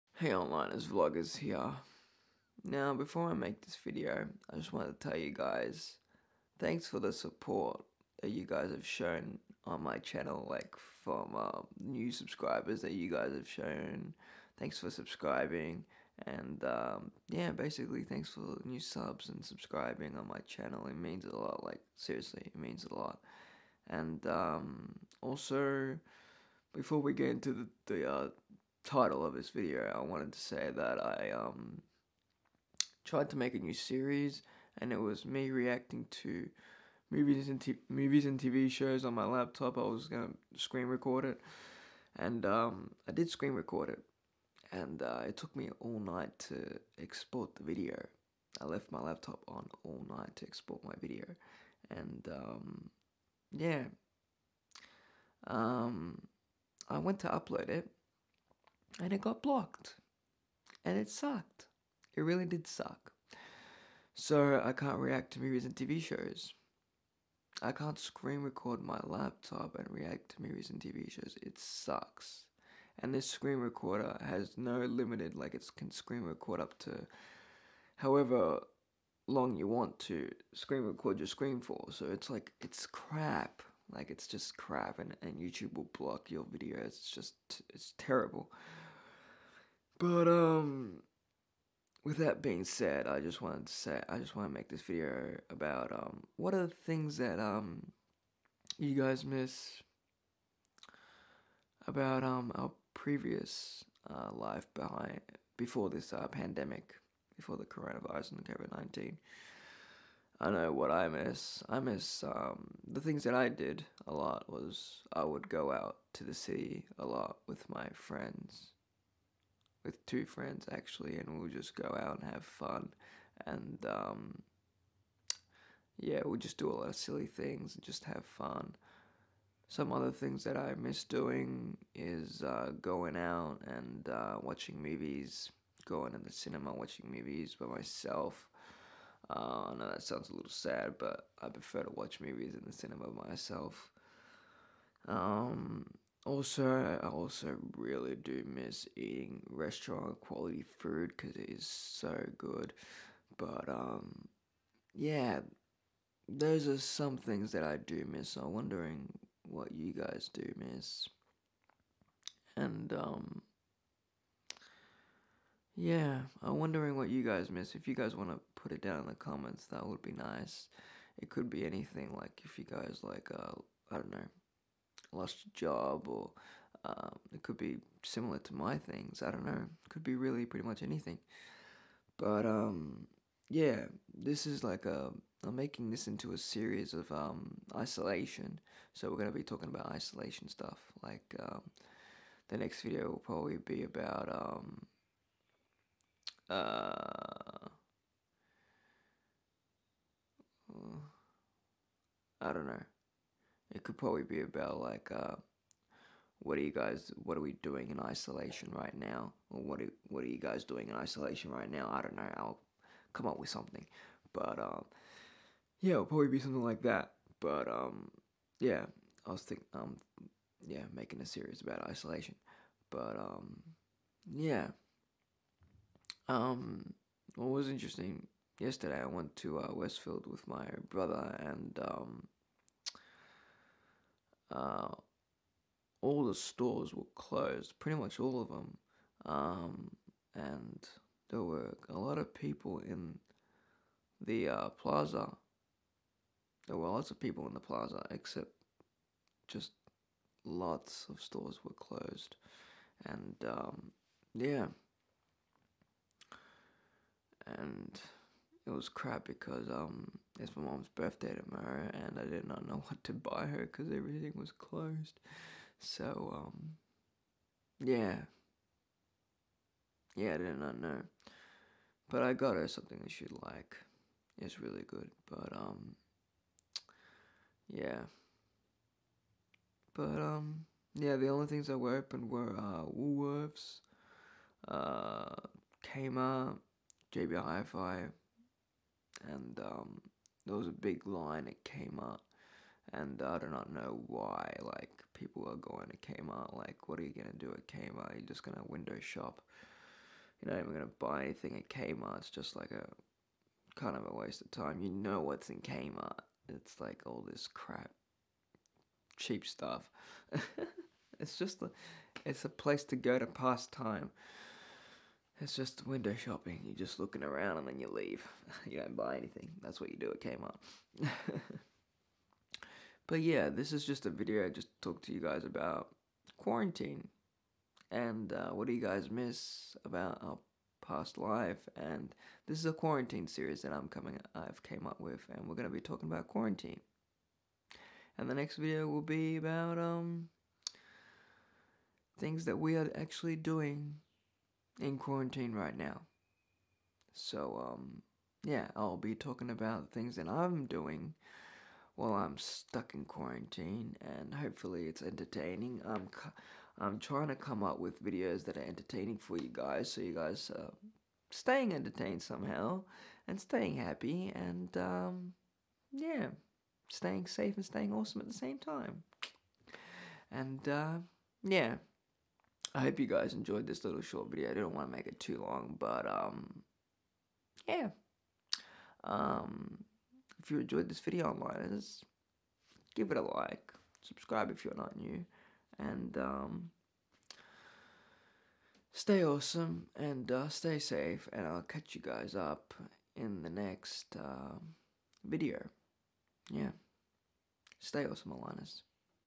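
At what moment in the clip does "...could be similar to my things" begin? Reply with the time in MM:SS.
02:57.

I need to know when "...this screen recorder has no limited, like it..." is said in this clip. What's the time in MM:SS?
01:13.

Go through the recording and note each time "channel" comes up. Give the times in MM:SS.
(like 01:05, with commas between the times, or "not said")
00:09, 00:20.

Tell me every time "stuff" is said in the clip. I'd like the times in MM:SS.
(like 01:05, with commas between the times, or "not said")
03:10, 05:09.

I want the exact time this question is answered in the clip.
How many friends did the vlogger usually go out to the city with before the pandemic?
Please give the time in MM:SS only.
02:00.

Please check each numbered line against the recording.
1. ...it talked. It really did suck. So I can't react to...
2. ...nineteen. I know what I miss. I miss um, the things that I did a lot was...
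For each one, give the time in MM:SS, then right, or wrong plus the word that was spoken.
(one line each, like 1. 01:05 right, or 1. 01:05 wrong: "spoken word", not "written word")
1. 01:00 wrong: "sucked", not "talked"
2. 01:48 right.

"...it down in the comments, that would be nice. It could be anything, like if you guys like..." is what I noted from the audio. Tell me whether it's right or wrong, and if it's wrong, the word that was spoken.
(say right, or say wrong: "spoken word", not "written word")
right.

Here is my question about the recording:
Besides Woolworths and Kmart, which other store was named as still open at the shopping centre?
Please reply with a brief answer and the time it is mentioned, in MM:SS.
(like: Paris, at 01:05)
JB Hi-Fi, at 04:47.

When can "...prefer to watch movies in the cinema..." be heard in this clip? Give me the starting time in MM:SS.
02:21.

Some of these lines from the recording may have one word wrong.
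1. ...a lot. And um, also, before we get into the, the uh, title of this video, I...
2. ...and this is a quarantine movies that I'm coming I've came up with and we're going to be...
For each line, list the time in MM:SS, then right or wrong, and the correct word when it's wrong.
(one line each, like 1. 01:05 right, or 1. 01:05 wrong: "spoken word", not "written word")
1. 00:22 right
2. 05:31 wrong: "series", not "movies".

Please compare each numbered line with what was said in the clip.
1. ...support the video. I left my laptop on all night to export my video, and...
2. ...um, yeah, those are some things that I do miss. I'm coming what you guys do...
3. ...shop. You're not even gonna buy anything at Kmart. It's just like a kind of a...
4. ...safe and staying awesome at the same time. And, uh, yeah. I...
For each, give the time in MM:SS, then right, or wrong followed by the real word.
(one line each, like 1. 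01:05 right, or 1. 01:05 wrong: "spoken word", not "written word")
1. 00:46 wrong: "export", not "support"
2. 02:33 wrong: "wondering", not "coming"
3. 04:58 right
4. 06:07 right.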